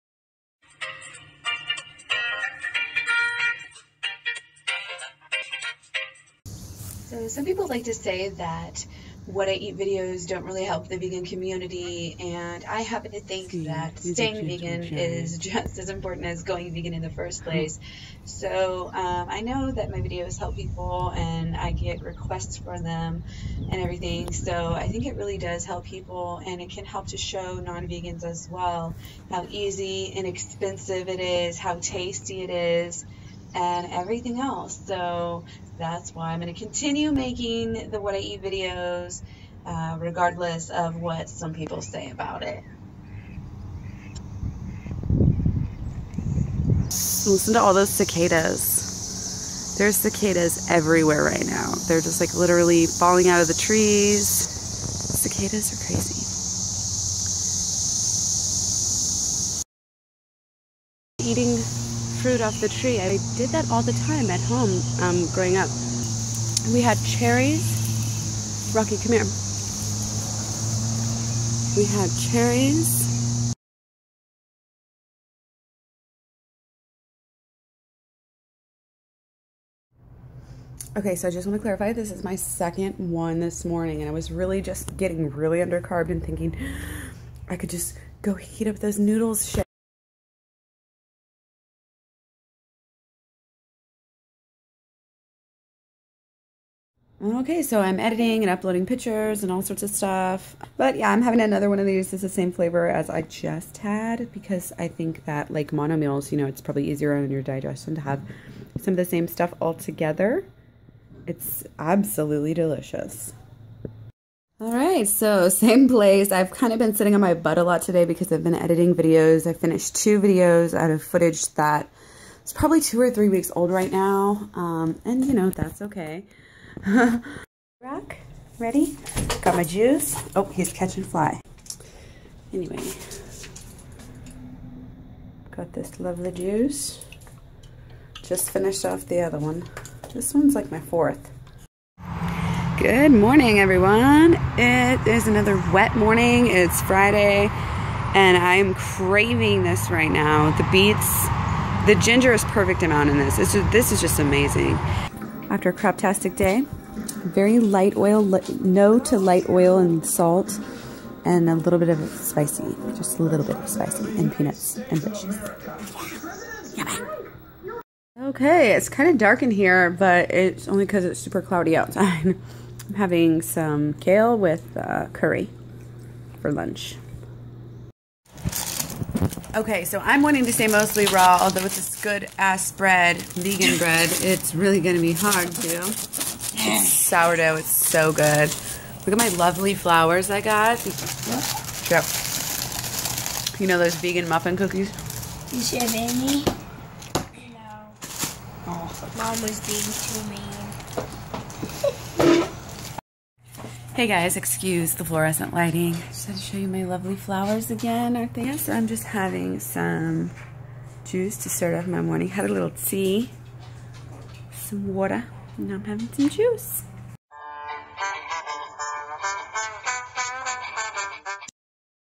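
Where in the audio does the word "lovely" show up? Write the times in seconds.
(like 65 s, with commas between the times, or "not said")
135 s, 189 s, 206 s.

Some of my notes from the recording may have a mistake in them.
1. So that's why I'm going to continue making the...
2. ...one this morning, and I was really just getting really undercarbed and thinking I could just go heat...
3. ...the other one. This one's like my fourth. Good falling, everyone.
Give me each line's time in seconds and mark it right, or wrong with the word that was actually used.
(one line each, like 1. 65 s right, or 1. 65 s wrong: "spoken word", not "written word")
1. 34 s right
2. 82 s right
3. 139 s wrong: "morning", not "falling".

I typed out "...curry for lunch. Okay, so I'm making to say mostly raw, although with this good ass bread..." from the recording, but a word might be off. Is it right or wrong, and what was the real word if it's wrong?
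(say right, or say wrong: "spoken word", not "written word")
wrong: "wanting", not "making".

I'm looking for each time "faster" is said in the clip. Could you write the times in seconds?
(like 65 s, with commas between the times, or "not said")
not said.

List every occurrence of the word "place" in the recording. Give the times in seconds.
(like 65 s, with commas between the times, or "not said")
17 s, 115 s.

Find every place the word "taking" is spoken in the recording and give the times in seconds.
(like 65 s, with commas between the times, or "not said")
not said.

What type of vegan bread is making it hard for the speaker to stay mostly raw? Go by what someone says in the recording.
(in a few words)
Sourdough.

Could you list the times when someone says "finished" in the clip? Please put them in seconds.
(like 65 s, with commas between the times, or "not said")
119 s, 138 s.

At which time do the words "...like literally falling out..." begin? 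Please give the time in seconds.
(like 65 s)
52 s.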